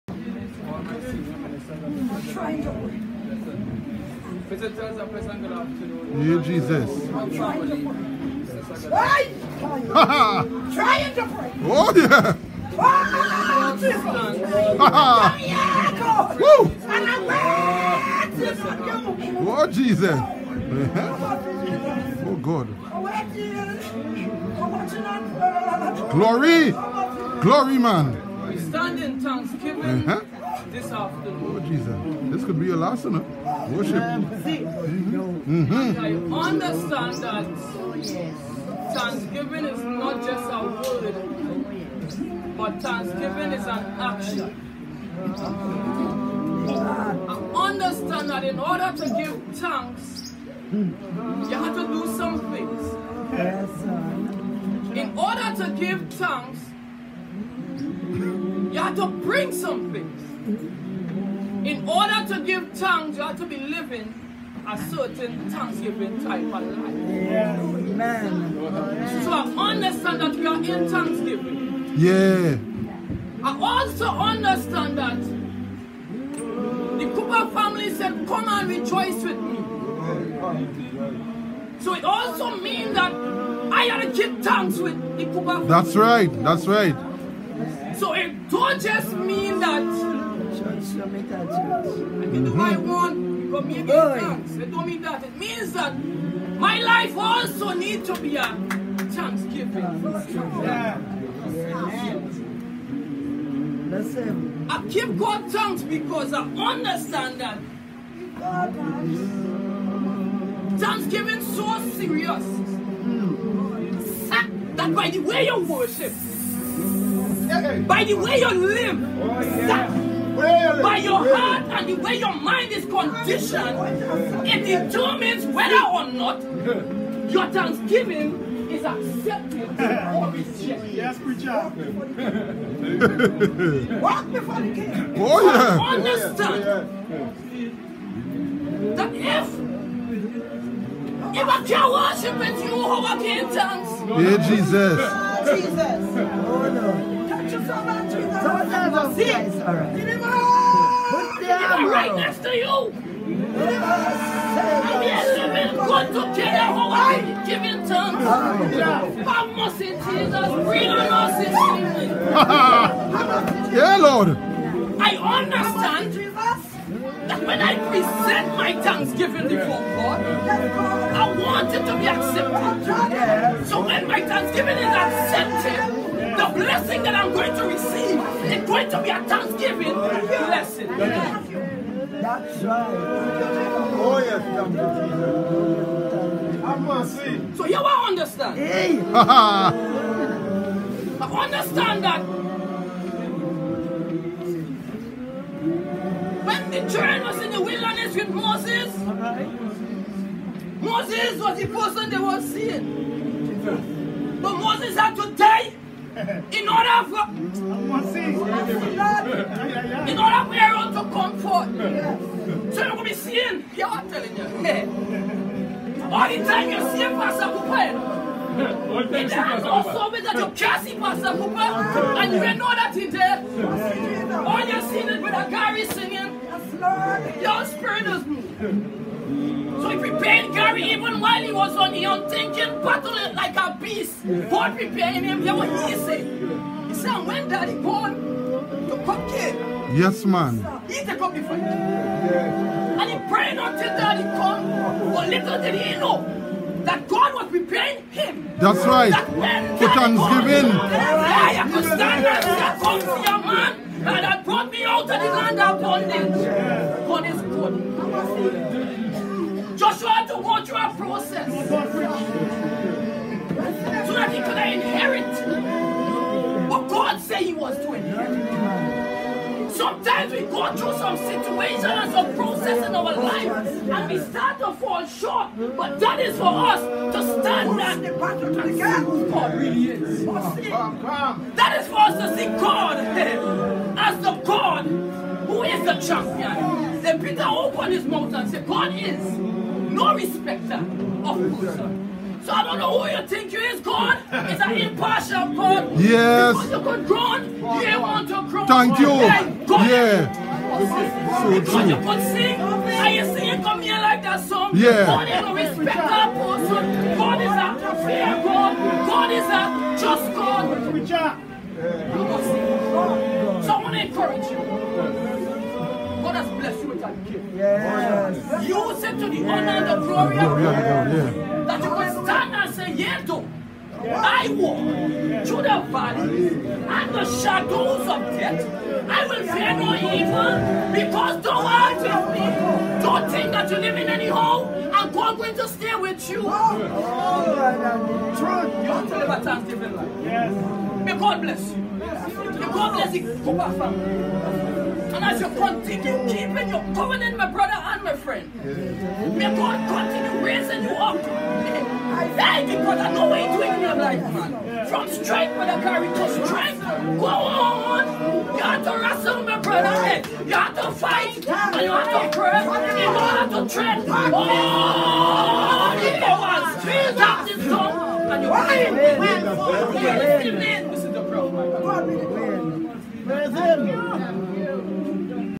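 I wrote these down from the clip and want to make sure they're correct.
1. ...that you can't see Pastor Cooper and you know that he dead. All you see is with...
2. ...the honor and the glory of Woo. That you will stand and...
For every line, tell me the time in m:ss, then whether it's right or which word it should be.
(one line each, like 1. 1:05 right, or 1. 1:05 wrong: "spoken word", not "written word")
1. 3:40 right
2. 5:19 wrong: "God", not "Woo".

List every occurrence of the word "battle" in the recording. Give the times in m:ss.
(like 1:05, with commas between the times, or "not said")
3:52, 4:38.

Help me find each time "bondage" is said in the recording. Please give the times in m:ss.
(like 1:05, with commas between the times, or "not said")
4:15.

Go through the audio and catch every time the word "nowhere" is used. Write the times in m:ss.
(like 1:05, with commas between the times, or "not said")
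not said.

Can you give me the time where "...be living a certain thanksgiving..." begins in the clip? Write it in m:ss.
1:03.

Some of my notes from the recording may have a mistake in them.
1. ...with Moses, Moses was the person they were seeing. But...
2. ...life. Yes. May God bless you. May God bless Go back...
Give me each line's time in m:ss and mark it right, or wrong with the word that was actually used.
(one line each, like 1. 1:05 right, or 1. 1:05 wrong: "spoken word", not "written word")
1. 3:18 right
2. 5:39 right.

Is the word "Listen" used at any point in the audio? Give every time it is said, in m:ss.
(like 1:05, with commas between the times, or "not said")
1:43.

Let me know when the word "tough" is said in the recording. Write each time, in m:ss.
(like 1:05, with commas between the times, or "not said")
not said.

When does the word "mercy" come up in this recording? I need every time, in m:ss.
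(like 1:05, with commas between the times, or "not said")
2:39.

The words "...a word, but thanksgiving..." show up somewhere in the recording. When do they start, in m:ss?
0:40.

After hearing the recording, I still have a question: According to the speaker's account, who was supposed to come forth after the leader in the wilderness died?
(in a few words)
Aaron.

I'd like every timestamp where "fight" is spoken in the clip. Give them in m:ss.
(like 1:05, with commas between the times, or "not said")
4:01, 6:00.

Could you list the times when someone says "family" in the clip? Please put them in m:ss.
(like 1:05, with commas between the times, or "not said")
1:17, 1:25, 5:43.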